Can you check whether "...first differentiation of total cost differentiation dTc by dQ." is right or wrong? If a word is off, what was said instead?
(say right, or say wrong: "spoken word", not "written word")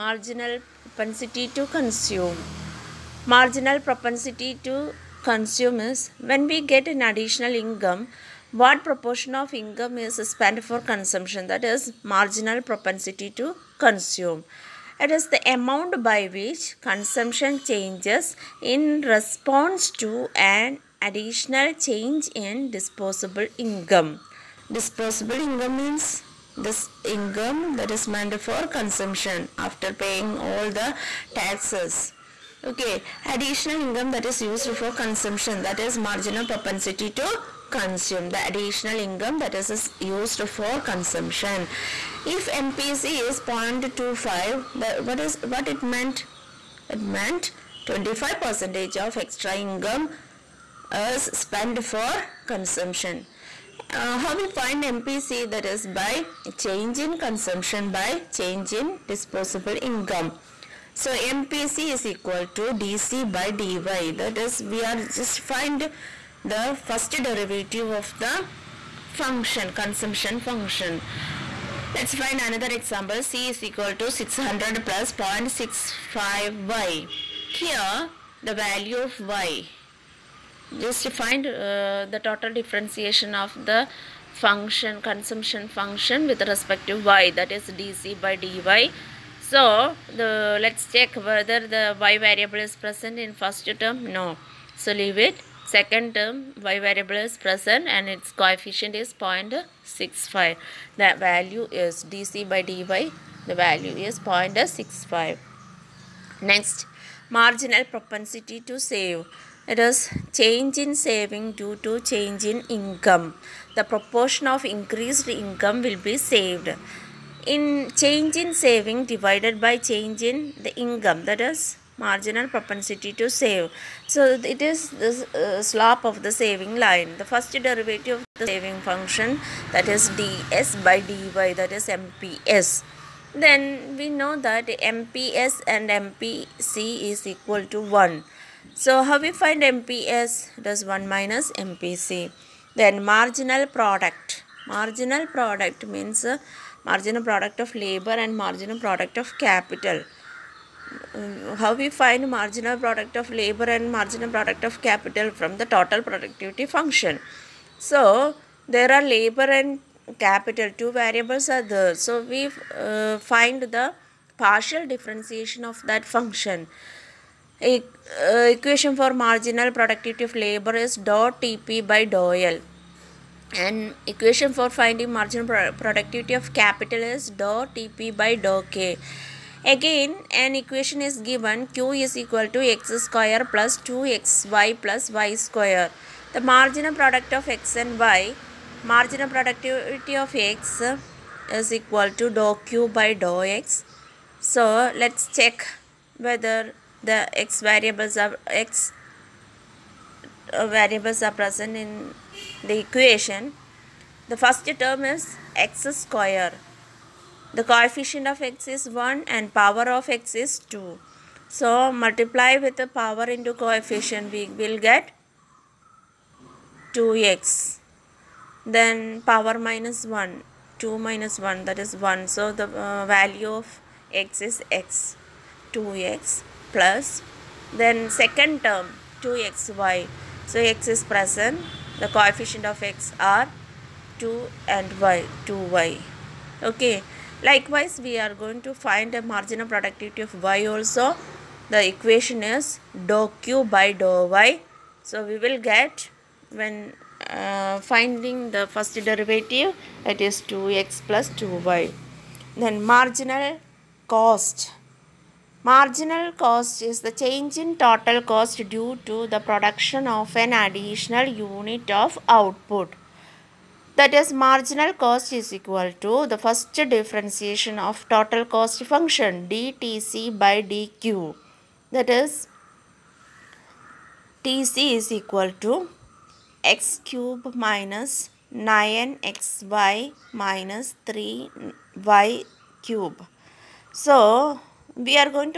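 wrong: "function", not "differentiation".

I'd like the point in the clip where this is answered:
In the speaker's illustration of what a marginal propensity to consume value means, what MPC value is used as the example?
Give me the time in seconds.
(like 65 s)
43 s.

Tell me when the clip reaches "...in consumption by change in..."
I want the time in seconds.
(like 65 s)
56 s.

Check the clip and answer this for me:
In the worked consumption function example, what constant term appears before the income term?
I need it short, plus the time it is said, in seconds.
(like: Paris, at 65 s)
600, at 74 s.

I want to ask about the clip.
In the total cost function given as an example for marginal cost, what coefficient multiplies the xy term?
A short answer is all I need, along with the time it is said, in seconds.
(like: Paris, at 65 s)
9, at 278 s.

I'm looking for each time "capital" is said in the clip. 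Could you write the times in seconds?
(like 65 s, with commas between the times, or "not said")
149 s, 154 s, 160 s, 176 s.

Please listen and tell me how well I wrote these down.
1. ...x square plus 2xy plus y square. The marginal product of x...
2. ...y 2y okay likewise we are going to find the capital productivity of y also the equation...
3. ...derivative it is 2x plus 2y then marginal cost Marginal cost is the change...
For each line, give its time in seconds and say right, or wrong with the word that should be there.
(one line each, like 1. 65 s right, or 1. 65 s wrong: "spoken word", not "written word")
1. 182 s right
2. 235 s wrong: "marginal", not "capital"
3. 249 s right.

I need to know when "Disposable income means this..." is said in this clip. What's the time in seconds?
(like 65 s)
24 s.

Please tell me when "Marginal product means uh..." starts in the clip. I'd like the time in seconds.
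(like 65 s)
144 s.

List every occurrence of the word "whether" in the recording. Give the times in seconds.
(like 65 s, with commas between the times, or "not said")
91 s, 196 s.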